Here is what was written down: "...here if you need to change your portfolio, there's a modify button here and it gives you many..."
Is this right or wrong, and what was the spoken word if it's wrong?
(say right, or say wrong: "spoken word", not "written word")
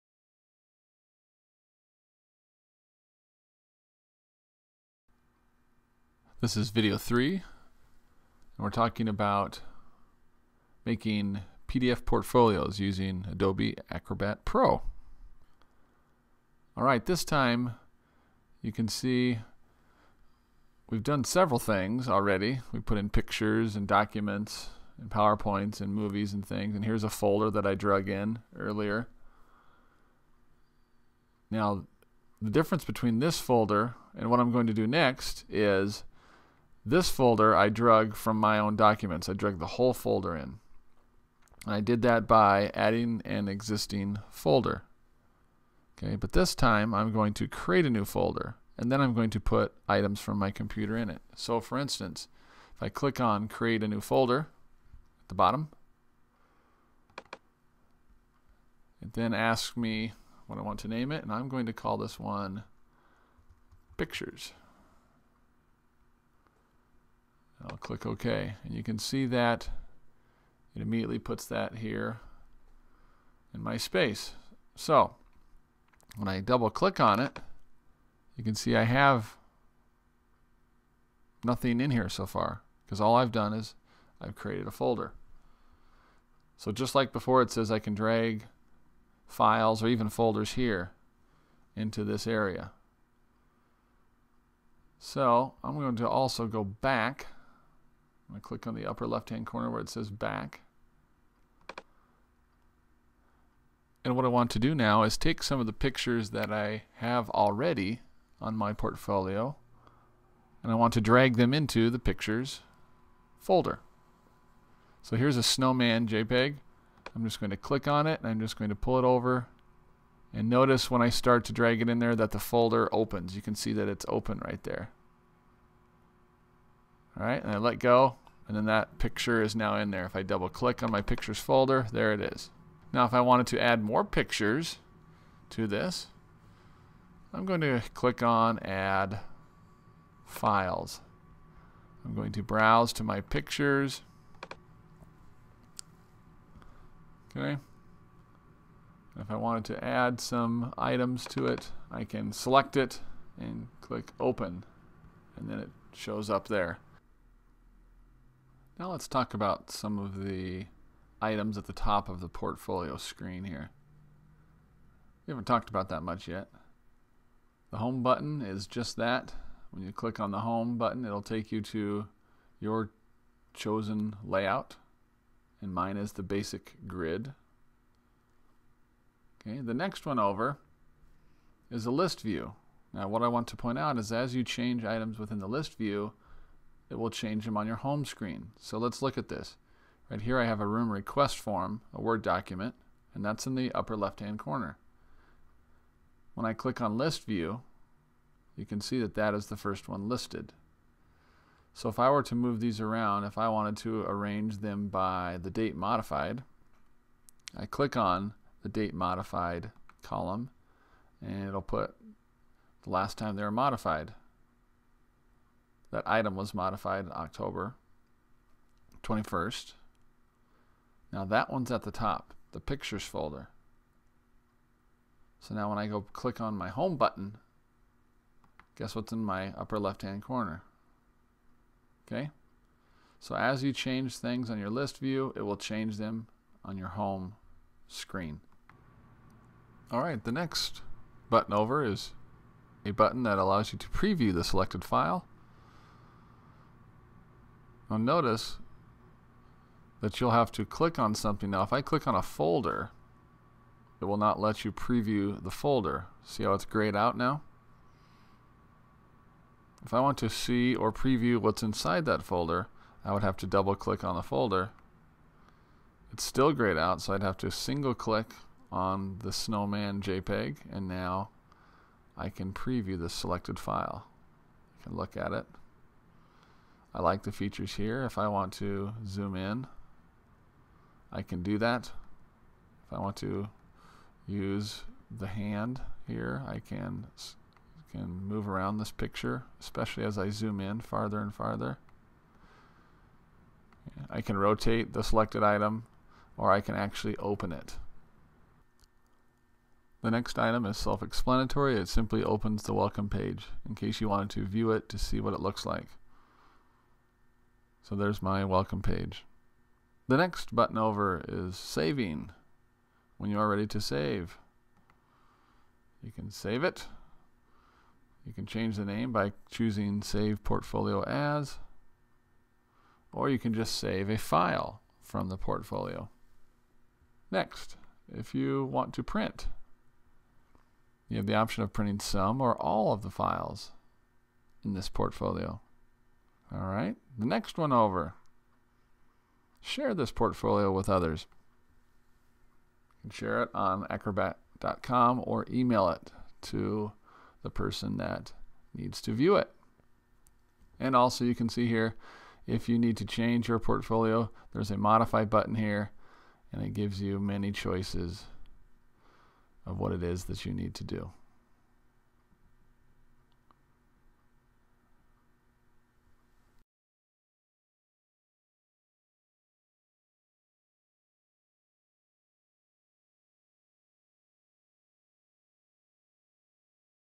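right.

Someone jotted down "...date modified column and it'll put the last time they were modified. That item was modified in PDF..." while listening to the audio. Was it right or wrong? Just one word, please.
wrong.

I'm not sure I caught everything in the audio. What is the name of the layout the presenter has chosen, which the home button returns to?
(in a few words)
basic grid.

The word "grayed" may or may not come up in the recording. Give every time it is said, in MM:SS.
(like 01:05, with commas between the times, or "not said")
04:16, 04:26.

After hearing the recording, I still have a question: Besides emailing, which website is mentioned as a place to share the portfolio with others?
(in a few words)
acrobat.com.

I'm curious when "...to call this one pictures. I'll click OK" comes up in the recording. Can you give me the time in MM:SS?
01:01.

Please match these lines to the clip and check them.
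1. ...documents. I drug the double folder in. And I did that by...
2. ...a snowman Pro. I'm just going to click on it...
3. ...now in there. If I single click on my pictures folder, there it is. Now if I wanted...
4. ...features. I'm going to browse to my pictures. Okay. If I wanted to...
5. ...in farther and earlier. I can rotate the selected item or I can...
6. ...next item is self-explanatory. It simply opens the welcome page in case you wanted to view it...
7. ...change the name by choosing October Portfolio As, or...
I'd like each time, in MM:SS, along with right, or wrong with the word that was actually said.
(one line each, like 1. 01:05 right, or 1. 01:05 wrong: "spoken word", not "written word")
1. 00:38 wrong: "whole", not "double"
2. 01:55 wrong: "JPEG", not "Pro"
3. 02:09 wrong: "double", not "single"
4. 02:20 wrong: "files", not "features"
5. 04:50 wrong: "farther", not "earlier"
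6. 05:00 right
7. 05:18 wrong: "Save", not "October".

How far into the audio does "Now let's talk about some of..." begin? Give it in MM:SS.
02:38.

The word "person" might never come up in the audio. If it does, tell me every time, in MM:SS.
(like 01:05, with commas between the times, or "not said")
05:47.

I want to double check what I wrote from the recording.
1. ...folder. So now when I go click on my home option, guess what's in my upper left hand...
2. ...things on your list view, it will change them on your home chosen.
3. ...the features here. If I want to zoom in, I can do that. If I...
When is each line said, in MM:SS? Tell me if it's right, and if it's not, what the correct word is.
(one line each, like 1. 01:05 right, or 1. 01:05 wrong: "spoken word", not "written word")
1. 03:43 wrong: "button", not "option"
2. 03:54 wrong: "screen", not "chosen"
3. 04:37 right.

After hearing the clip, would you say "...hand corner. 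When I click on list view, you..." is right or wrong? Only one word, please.
right.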